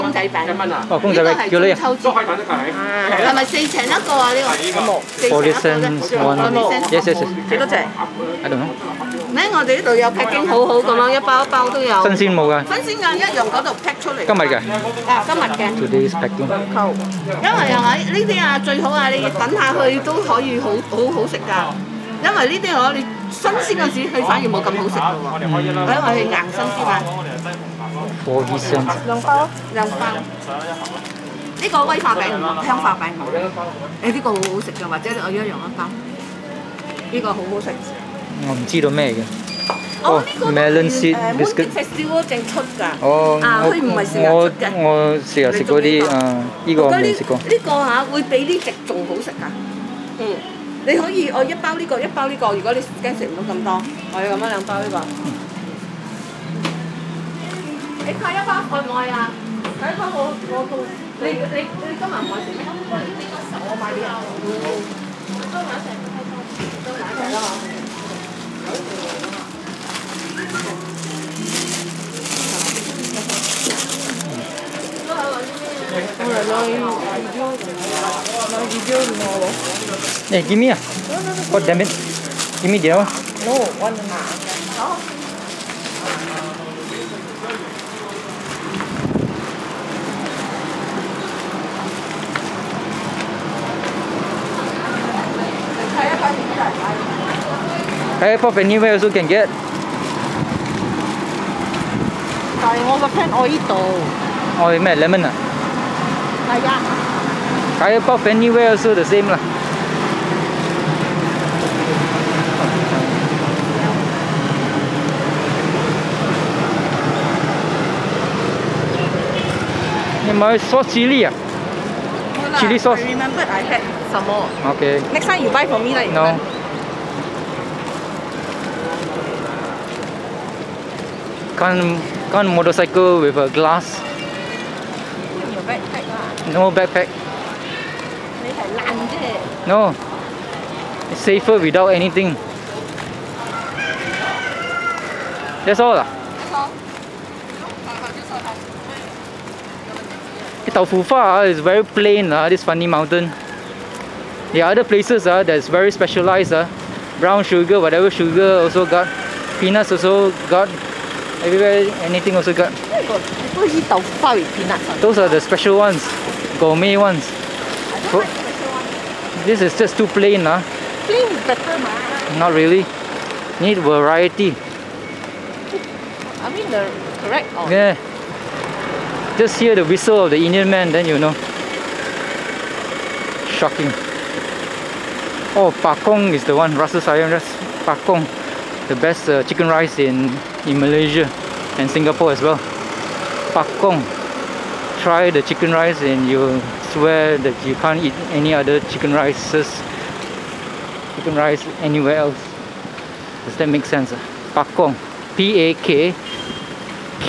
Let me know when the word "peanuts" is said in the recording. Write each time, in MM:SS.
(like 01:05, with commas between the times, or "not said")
02:39, 02:44.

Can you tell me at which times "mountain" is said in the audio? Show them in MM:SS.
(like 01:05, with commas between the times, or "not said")
02:32.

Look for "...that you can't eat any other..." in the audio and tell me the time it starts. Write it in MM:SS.
03:17.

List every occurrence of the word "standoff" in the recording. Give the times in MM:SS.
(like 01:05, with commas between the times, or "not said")
not said.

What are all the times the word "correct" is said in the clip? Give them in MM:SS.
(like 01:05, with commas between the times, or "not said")
02:57.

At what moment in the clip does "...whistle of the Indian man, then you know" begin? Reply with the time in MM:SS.
02:59.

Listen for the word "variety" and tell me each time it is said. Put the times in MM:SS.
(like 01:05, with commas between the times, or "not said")
02:53.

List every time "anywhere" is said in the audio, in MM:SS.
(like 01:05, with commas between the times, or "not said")
01:38, 01:48, 03:21.